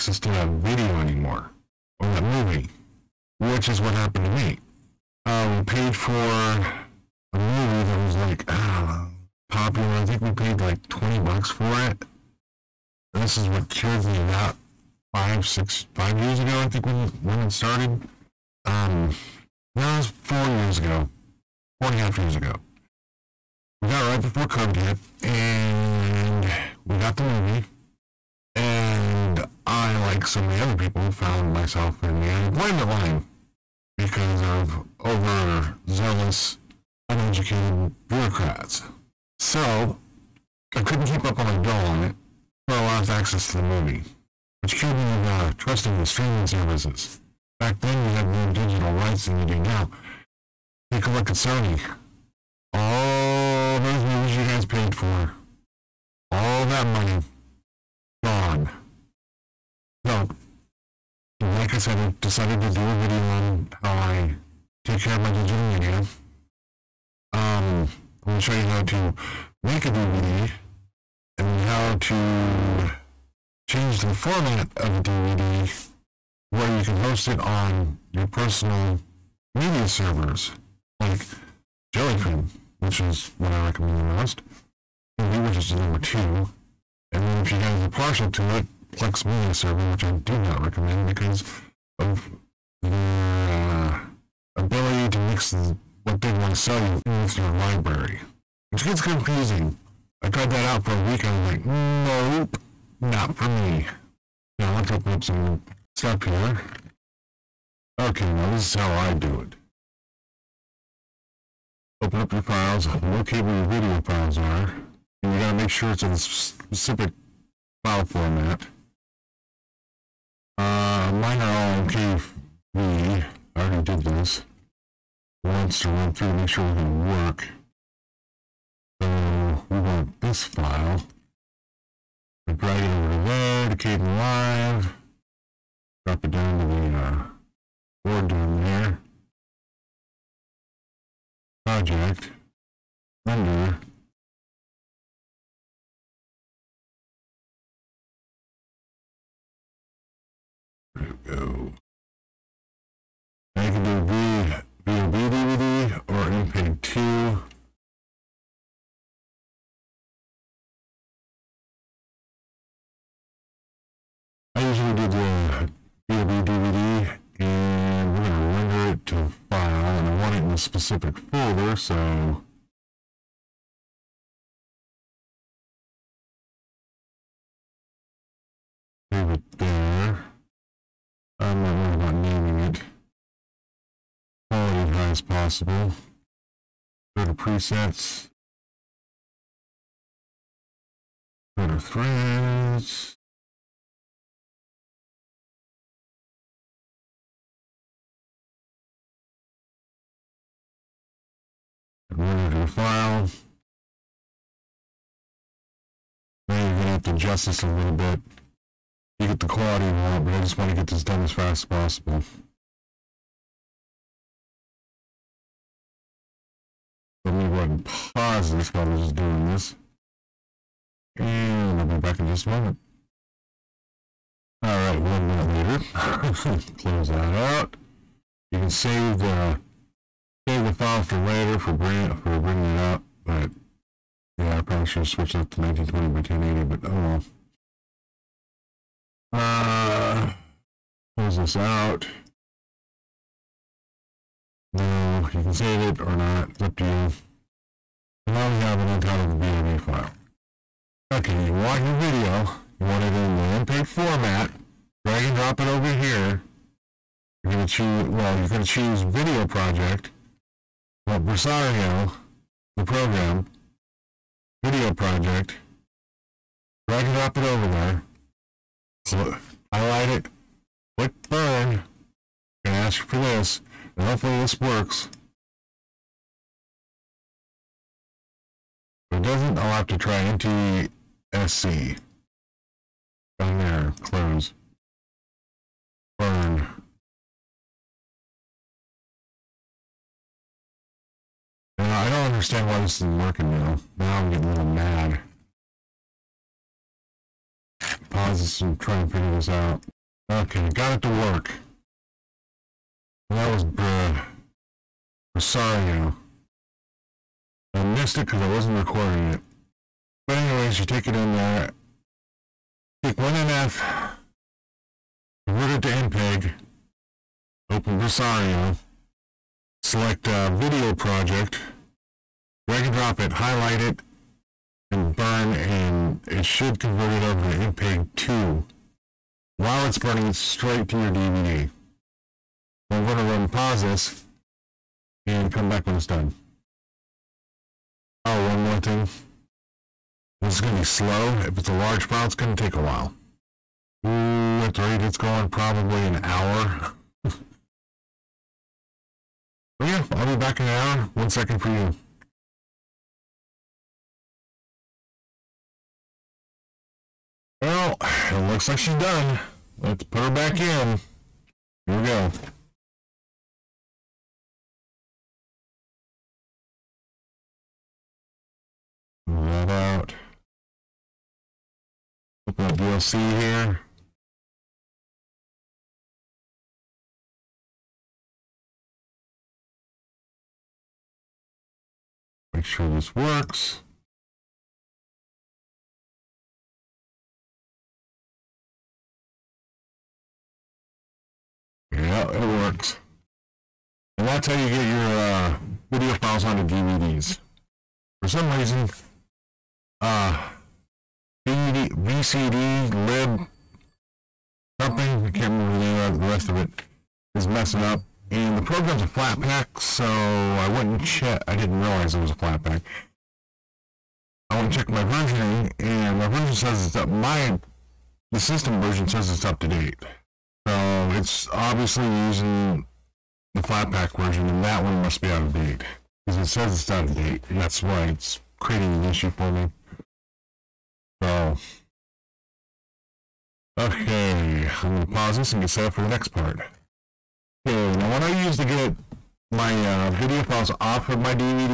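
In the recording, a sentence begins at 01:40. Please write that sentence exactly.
I tried that out for a week and I was like, nope, not for me.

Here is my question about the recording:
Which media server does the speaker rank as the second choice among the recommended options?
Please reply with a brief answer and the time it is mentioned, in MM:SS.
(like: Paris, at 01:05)
Emby, at 01:25.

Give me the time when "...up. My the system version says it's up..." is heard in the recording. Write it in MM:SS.
06:56.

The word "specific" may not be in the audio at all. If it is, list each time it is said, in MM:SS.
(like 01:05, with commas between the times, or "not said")
01:56, 02:50.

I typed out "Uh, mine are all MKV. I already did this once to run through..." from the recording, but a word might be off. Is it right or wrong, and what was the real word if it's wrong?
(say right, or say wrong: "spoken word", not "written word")
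right.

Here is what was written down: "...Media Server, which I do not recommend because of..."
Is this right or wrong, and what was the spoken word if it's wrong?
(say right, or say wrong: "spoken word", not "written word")
right.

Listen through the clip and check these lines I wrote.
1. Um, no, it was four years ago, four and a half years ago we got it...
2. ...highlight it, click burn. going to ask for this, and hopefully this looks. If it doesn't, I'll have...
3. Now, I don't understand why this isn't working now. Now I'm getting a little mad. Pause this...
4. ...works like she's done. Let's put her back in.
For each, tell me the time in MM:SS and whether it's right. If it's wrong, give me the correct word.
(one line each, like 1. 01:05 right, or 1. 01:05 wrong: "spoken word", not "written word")
1. 00:18 right
2. 04:29 wrong: "works", not "looks"
3. 04:51 right
4. 05:58 wrong: "looks", not "works".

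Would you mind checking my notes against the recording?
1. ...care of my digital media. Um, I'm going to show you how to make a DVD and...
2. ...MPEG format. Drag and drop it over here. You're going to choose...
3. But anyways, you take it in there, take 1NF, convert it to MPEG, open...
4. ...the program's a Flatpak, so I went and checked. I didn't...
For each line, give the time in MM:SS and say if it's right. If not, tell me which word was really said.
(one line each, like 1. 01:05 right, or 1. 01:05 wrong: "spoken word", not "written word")
1. 01:05 right
2. 04:13 right
3. 05:10 right
4. 06:48 right.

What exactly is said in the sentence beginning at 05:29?
While it's burning, it straight to your DVD.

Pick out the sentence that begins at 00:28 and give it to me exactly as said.
And I, like so many other people, found myself in the unemployment line because of overzealous, uneducated bureaucrats.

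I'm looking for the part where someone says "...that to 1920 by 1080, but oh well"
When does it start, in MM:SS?
03:55.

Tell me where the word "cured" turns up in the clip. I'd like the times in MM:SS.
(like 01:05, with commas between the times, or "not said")
00:13, 00:44.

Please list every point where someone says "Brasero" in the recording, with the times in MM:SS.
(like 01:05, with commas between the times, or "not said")
04:21, 05:17.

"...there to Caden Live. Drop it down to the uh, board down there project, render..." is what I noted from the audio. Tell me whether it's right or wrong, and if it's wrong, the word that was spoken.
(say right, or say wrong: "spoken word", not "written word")
right.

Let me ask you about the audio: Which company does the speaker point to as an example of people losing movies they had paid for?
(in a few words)
Sony.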